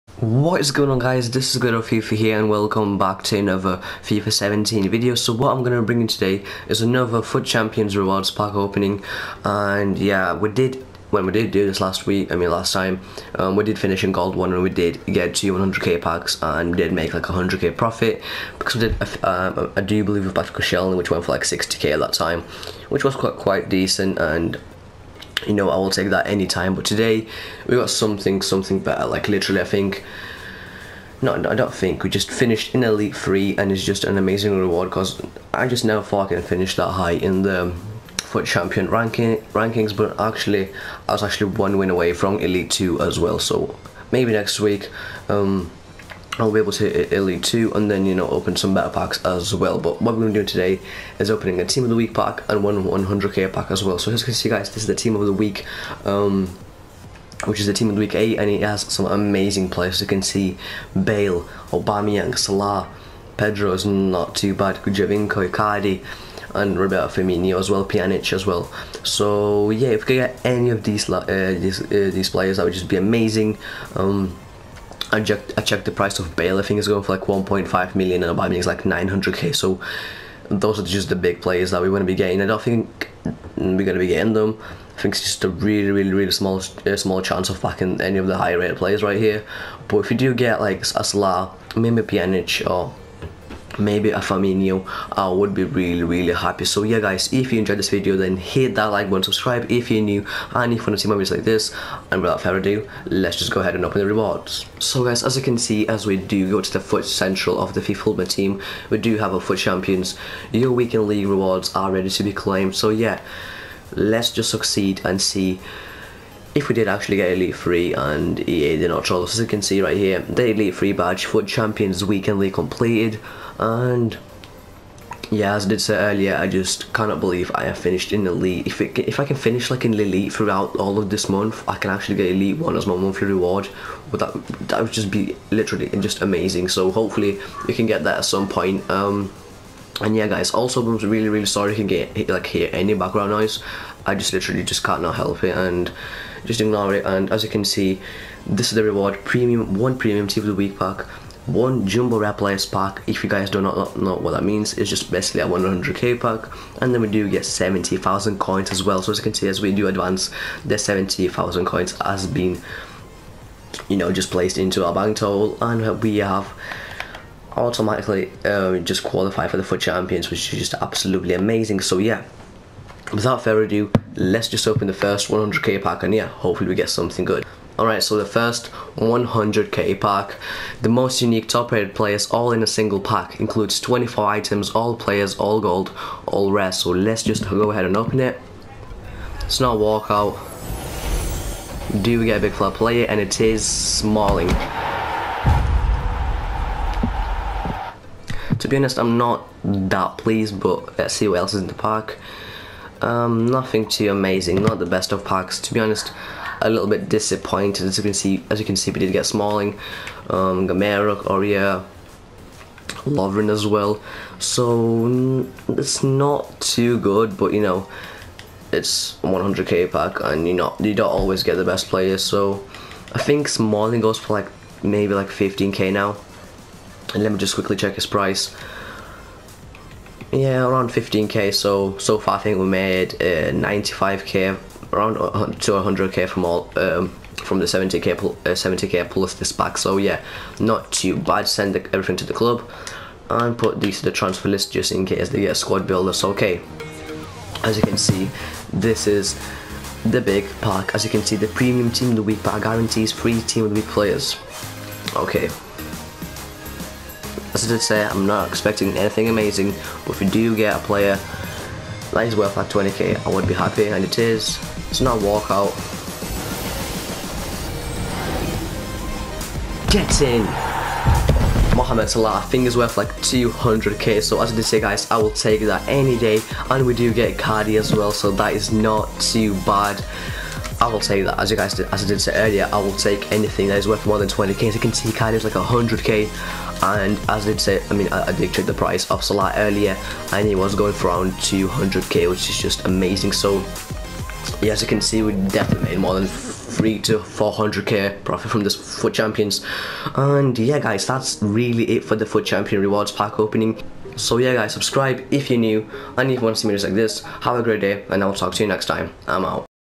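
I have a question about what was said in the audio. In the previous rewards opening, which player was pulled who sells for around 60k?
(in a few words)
Patrick O'Shelly.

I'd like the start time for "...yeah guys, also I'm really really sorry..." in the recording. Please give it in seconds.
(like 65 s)
140 s.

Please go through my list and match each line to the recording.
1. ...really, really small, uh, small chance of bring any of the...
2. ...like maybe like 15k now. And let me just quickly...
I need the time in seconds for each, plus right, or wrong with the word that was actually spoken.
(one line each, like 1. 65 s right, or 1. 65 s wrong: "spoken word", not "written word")
1. 85 s wrong: "backing", not "bring"
2. 224 s right.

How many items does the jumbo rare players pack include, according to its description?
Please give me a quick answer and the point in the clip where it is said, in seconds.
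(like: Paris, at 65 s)
24, at 183 s.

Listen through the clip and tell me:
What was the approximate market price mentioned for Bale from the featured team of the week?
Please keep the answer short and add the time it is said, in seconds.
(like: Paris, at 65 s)
1.5 million, at 77 s.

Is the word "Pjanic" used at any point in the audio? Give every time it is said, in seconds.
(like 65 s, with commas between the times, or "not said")
67 s, 92 s.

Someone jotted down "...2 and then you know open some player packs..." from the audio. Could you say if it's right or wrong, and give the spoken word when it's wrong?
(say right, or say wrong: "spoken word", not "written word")
wrong: "better", not "player".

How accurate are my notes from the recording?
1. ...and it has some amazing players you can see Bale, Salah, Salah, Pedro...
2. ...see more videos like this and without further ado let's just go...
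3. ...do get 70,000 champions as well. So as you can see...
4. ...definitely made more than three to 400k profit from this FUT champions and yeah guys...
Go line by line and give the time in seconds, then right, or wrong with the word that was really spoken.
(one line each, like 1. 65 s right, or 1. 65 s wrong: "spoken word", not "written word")
1. 58 s wrong: "Aubameyang", not "Salah"
2. 100 s right
3. 157 s wrong: "coins", not "champions"
4. 295 s right.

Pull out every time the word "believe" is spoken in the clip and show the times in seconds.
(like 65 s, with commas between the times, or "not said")
20 s, 127 s.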